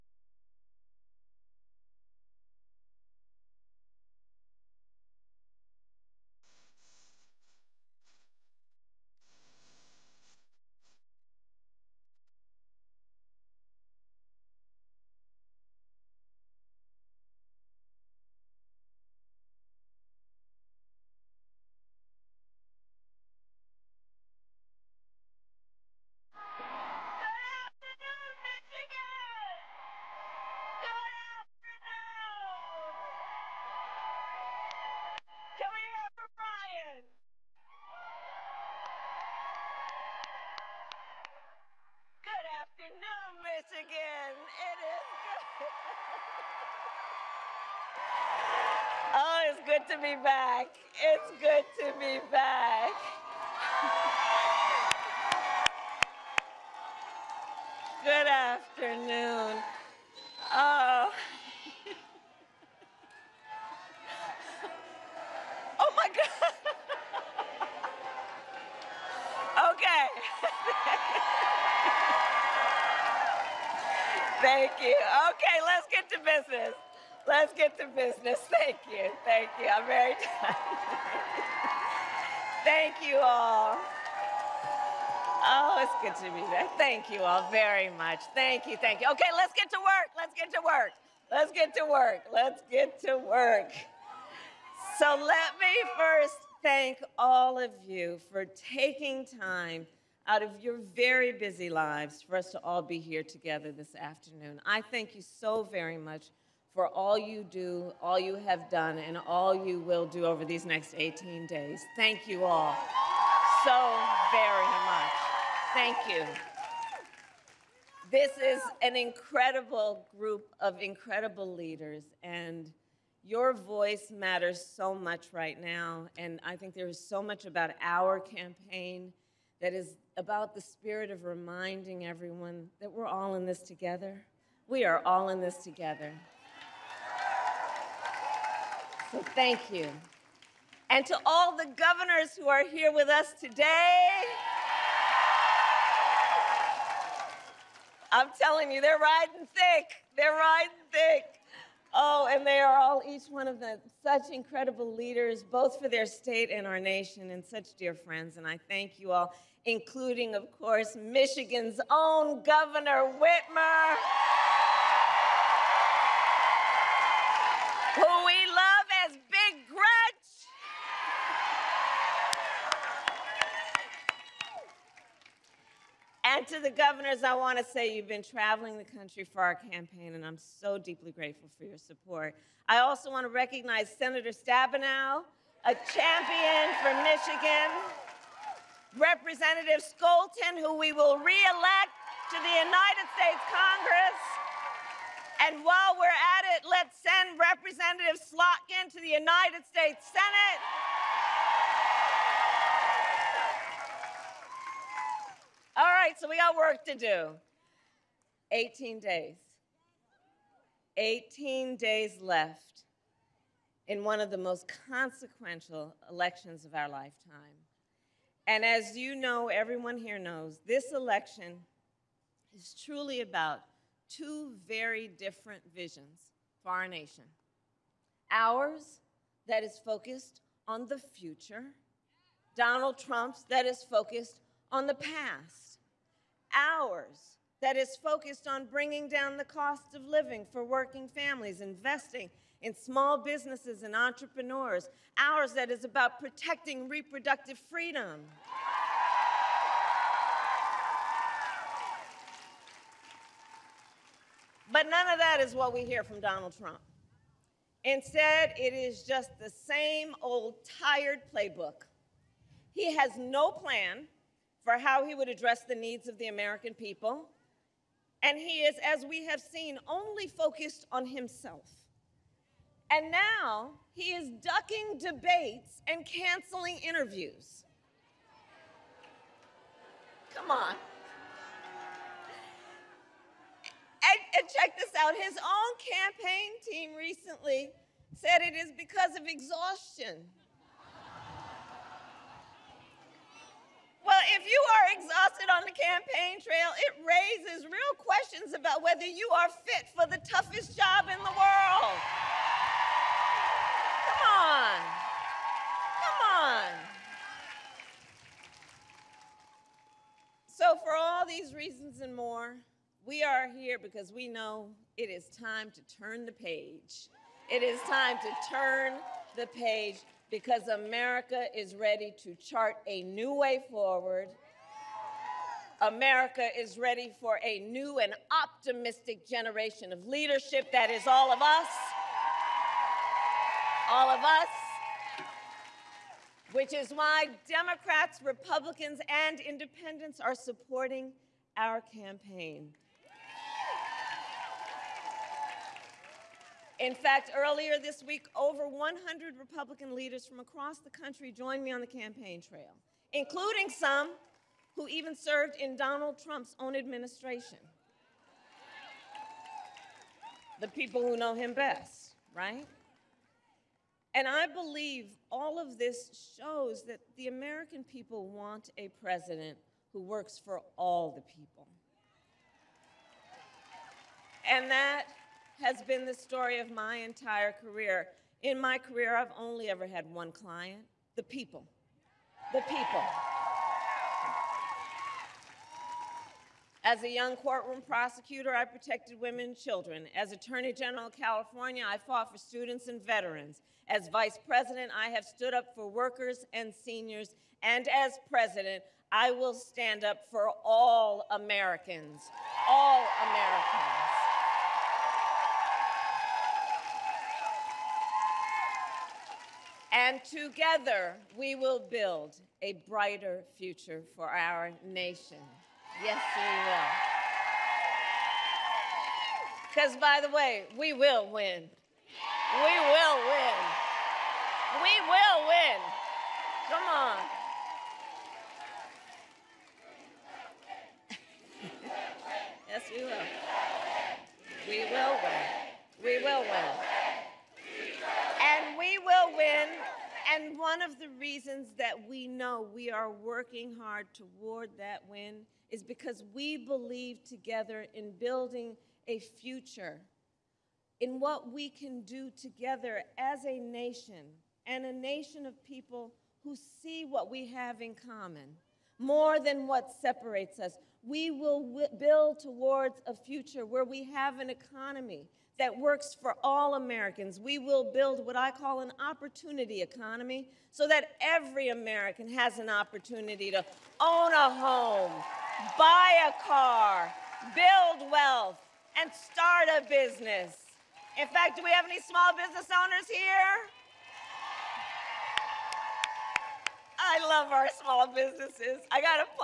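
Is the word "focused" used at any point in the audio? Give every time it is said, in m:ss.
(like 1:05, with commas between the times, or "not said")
3:49, 3:53, 3:58, 4:30.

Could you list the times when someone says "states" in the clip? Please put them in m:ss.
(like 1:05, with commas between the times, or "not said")
2:36, 3:13, 3:19.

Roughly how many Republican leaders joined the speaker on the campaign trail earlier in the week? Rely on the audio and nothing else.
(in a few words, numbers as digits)
over 100.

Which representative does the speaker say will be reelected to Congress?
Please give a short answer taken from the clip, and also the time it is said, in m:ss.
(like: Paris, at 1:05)
Scholten, at 3:08.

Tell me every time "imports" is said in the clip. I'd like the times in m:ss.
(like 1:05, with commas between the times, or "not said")
not said.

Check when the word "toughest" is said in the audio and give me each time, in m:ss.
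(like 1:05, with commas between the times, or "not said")
5:00.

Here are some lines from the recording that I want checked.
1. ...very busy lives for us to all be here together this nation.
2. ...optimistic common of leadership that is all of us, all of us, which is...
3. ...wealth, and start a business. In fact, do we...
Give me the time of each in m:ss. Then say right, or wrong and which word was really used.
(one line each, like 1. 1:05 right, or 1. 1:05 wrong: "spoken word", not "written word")
1. 1:40 wrong: "afternoon", not "nation"
2. 5:28 wrong: "generation", not "common"
3. 7:58 right.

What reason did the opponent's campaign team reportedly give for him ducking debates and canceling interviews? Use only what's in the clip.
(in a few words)
exhaustion.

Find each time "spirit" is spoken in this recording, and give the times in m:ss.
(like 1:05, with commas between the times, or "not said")
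2:10.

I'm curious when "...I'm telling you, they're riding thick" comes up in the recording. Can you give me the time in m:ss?
2:28.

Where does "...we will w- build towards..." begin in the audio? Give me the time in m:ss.
7:41.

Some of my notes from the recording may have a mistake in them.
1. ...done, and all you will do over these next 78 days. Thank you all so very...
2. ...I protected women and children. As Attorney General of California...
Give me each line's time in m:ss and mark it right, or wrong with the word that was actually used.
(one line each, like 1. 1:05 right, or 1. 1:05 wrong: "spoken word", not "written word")
1. 1:48 wrong: "18", not "78"
2. 6:28 right.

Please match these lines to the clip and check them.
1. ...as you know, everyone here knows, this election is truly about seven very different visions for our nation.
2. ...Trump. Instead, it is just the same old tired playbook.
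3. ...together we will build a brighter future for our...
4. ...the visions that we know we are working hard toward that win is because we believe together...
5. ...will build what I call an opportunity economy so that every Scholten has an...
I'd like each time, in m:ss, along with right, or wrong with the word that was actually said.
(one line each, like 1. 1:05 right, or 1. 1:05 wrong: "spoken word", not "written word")
1. 3:38 wrong: "two", not "seven"
2. 4:16 right
3. 6:50 right
4. 7:20 wrong: "reasons", not "visions"
5. 7:47 wrong: "American", not "Scholten".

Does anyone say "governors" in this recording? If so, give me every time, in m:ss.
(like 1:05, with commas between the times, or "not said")
2:21, 2:42, 2:56.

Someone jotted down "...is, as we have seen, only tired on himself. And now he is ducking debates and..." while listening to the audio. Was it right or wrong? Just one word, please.
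wrong.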